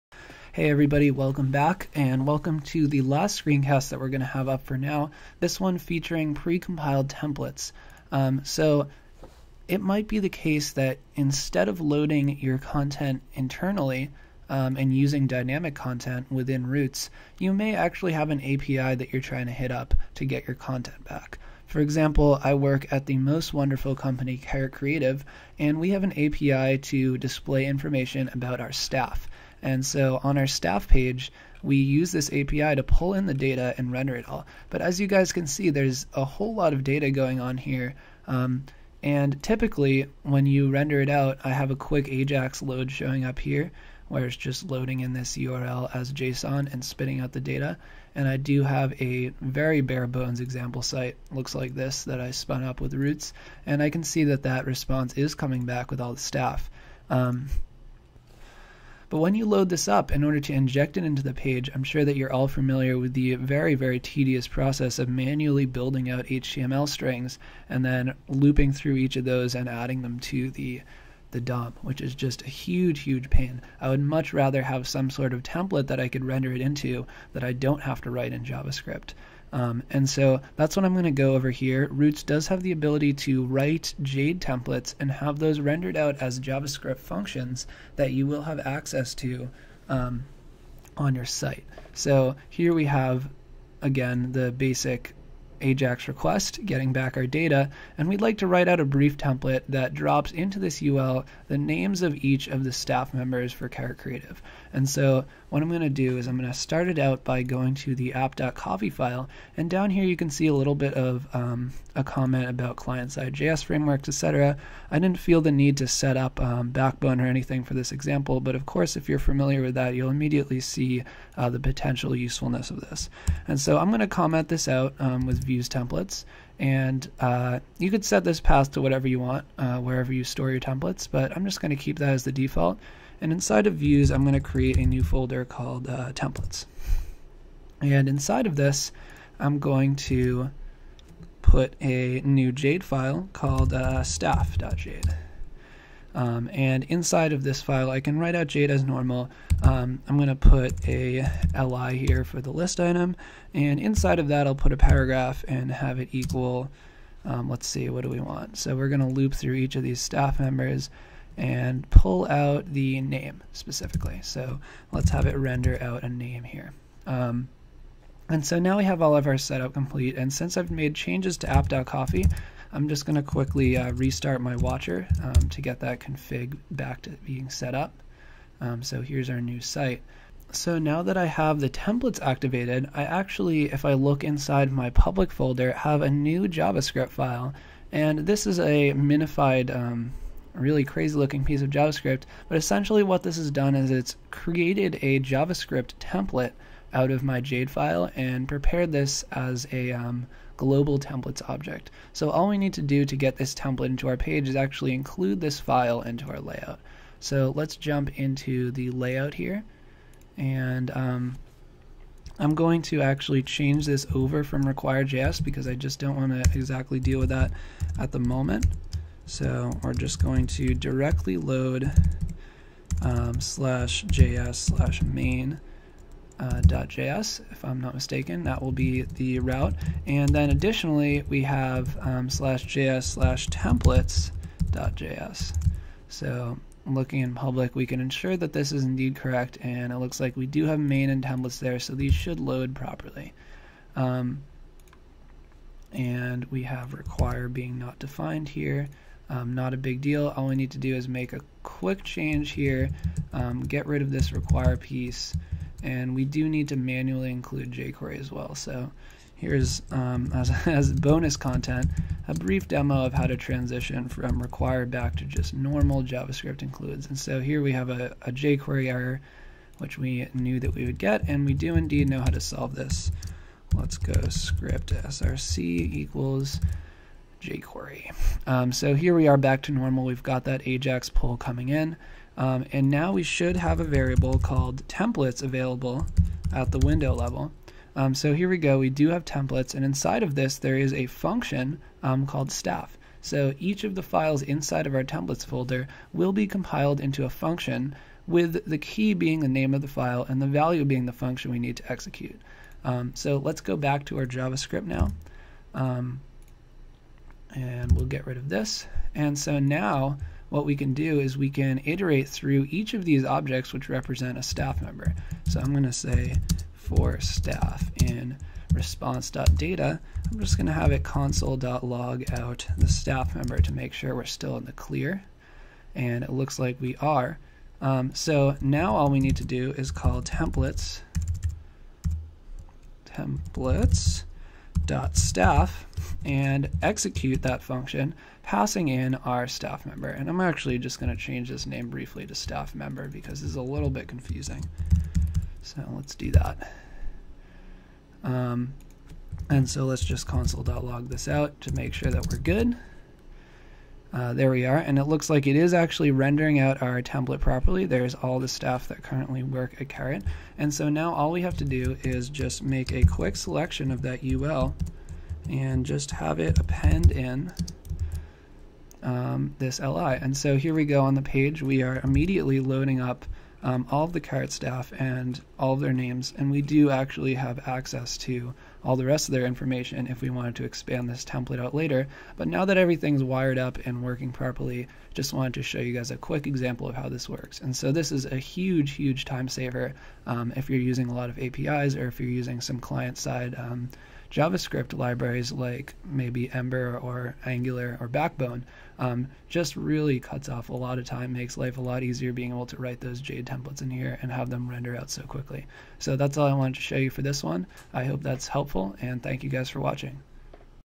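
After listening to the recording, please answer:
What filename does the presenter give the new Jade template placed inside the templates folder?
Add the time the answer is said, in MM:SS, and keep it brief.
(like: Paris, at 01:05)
staff.jade, at 02:24.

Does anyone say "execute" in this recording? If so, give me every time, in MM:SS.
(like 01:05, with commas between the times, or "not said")
05:01, 05:36.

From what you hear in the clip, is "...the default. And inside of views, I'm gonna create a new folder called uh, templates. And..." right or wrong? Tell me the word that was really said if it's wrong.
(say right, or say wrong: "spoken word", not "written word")
right.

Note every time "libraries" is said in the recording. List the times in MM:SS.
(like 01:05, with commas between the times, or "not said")
06:34.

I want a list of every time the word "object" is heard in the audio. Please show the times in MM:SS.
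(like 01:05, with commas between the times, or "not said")
03:21, 05:13.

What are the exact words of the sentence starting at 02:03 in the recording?
And so I'm going to comment this out um, with use templates.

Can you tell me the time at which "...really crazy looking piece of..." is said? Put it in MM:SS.
03:10.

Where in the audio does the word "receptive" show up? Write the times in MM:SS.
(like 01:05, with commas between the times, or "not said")
not said.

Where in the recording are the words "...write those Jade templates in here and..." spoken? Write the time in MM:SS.
06:42.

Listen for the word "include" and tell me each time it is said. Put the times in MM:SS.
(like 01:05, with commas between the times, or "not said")
03:24, 04:17, 04:26.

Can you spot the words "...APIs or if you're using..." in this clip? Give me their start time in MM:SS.
06:31.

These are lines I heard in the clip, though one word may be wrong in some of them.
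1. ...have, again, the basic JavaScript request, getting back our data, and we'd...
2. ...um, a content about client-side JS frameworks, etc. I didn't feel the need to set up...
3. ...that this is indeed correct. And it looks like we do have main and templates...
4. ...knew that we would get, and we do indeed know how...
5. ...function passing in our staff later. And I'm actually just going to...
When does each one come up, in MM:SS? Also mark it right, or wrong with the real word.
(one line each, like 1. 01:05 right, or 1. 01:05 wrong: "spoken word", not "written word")
1. 01:32 wrong: "AJAX", not "JavaScript"
2. 01:51 wrong: "comment", not "content"
3. 03:58 right
4. 04:30 right
5. 05:37 wrong: "member", not "later".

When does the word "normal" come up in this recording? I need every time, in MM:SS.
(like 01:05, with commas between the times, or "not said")
02:28, 04:25, 04:39.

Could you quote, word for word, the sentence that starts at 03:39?
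So we're just going to directly load um, slash js slash main uh, .js, if I'm not mistaken.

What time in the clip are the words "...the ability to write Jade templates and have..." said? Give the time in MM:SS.
01:22.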